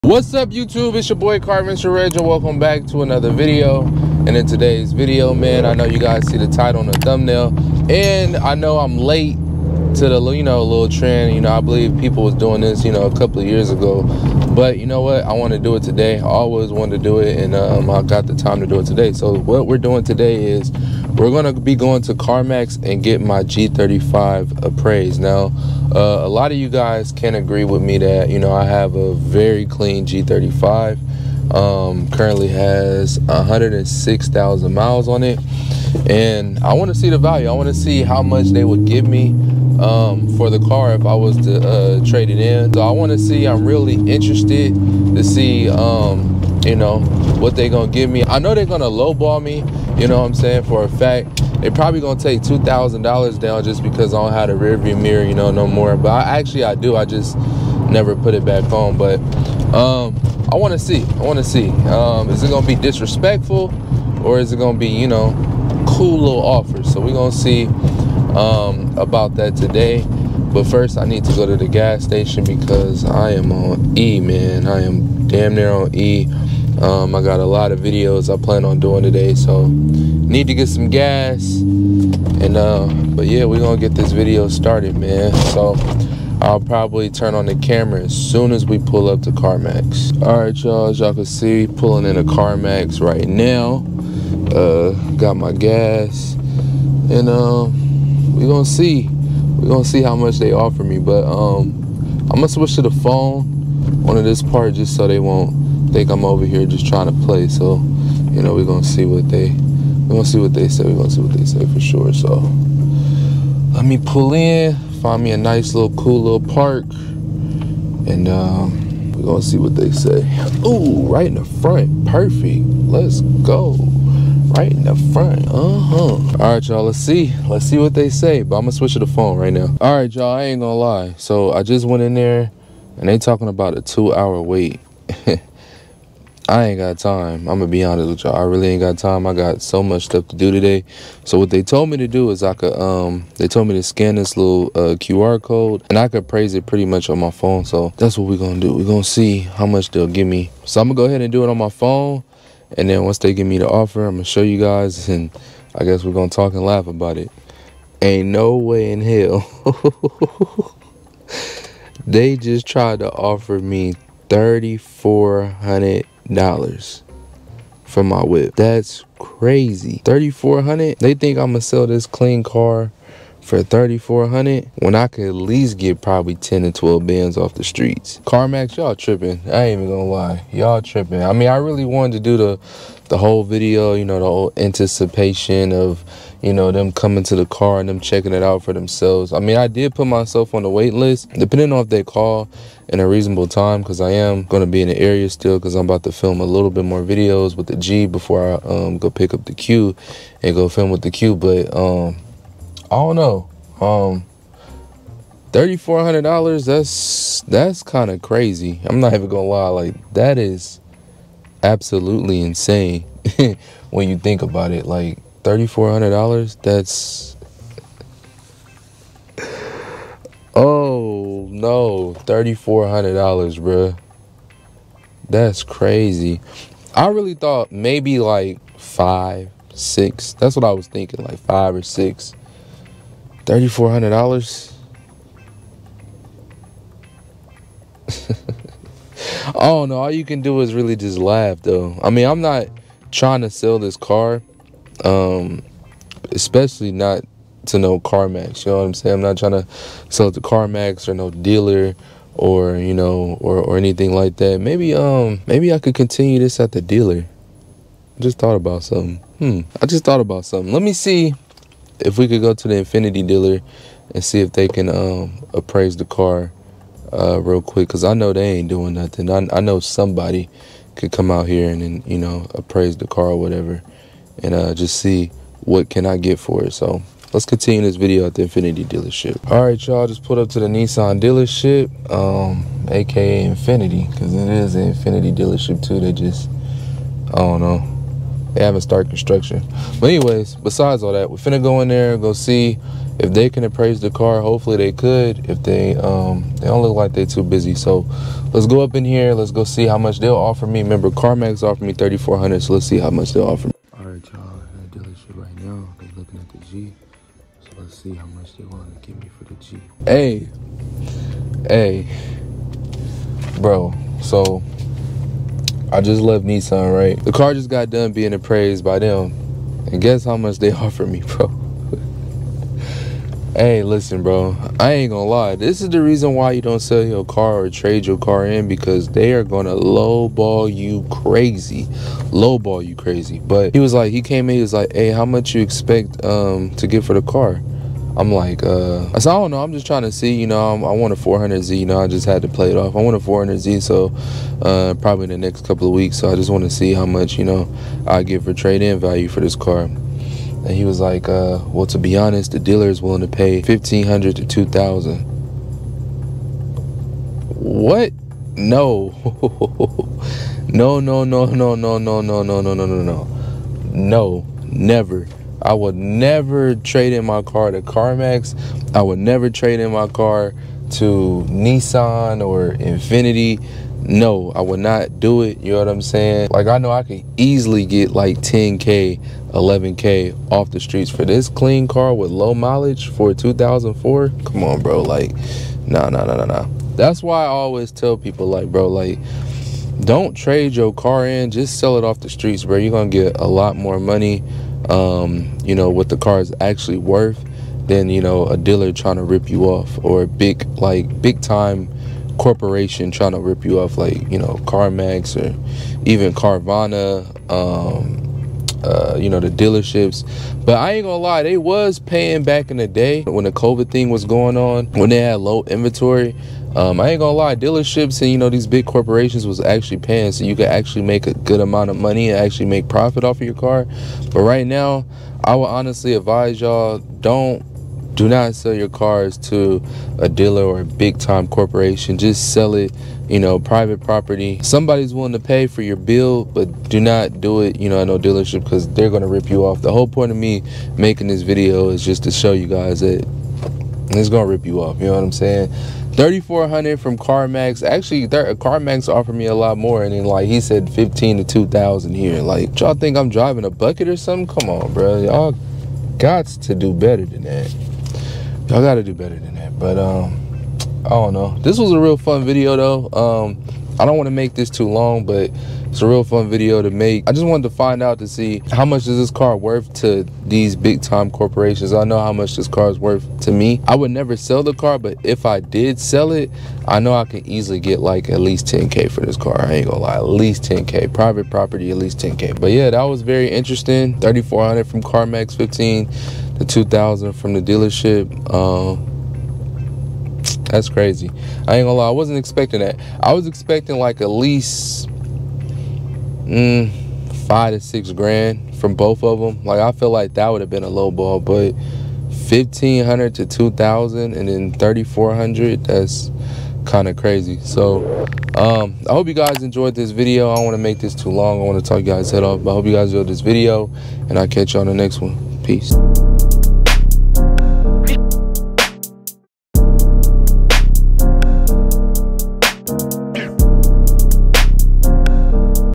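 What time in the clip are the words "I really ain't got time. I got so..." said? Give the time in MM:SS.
02:18.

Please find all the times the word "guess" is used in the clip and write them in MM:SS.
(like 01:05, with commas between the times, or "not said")
02:35, 05:20.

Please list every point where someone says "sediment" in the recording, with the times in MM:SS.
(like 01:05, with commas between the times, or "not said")
not said.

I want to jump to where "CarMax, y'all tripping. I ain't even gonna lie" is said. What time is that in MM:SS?
02:58.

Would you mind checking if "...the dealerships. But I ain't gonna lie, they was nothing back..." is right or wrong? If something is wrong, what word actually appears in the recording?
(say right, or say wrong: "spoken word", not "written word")
wrong: "paying", not "nothing".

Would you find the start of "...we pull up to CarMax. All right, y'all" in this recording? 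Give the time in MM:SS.
01:28.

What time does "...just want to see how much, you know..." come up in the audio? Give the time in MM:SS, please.
05:46.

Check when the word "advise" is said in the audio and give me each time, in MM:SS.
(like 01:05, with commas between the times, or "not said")
07:06.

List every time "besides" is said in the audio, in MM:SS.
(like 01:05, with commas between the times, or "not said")
04:50.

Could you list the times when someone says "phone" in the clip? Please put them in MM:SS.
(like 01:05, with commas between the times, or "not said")
01:42, 02:09, 02:27, 02:31.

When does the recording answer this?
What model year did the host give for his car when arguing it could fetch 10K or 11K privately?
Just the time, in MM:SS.
06:23.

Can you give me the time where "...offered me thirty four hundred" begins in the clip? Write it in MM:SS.
05:01.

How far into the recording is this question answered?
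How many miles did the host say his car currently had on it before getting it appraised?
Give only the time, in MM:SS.
00:33.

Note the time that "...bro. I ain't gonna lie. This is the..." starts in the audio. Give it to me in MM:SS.
05:24.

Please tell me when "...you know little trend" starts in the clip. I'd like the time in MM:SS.
00:10.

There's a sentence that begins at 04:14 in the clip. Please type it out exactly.
Maybe um maybe I could continue this at the dealer.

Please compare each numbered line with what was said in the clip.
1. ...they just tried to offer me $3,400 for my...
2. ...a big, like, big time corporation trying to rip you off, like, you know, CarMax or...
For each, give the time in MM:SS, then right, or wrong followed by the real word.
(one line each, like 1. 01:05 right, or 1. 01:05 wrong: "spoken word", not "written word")
1. 02:42 right
2. 06:40 right.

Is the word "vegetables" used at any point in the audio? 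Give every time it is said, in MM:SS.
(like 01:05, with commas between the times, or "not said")
not said.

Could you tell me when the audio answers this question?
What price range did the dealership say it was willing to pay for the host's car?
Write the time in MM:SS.
05:53.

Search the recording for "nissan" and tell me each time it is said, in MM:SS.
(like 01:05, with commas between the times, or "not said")
04:40, 05:16, 06:11.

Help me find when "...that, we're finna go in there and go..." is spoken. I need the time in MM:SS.
04:51.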